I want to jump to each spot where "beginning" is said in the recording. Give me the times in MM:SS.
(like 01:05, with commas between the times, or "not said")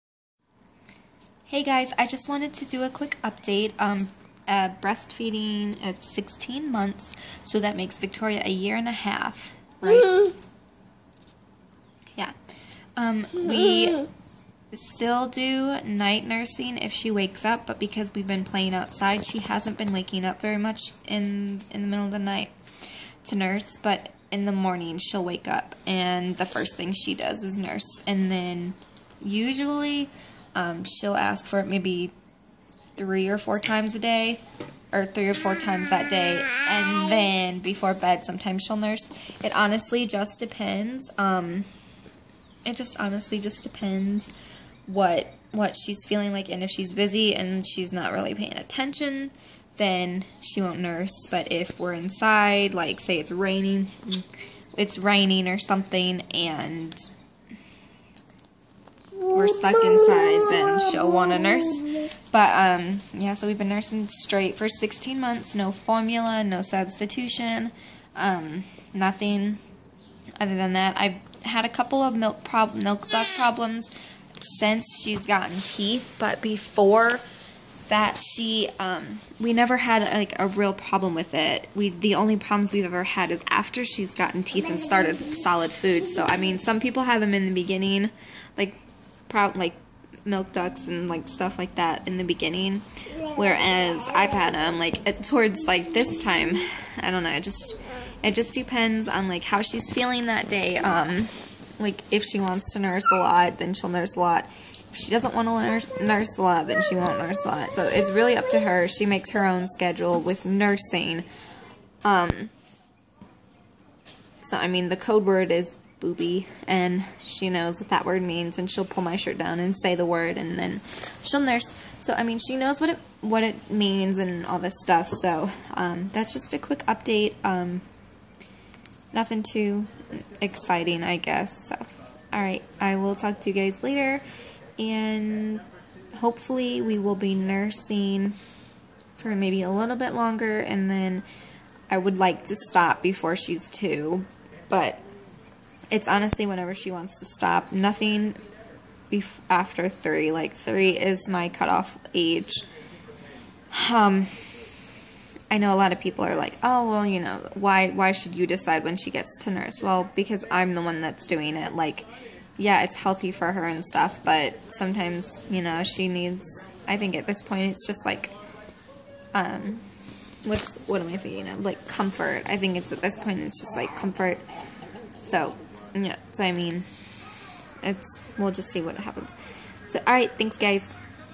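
01:27, 01:32.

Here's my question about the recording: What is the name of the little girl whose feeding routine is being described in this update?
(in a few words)
Victoria.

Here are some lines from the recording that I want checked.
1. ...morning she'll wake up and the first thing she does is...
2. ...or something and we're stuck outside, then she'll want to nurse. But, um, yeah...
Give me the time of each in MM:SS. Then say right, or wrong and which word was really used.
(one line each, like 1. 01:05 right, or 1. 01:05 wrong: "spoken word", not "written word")
1. 00:24 right
2. 00:55 wrong: "inside", not "outside".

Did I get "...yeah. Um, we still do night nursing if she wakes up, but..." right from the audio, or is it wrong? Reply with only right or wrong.
right.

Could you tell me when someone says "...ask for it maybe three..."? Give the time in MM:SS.
00:31.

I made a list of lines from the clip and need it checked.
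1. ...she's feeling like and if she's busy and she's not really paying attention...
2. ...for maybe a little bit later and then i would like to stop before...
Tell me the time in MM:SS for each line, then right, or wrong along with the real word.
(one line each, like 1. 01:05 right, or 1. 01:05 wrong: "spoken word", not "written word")
1. 00:45 right
2. 02:19 wrong: "longer", not "later".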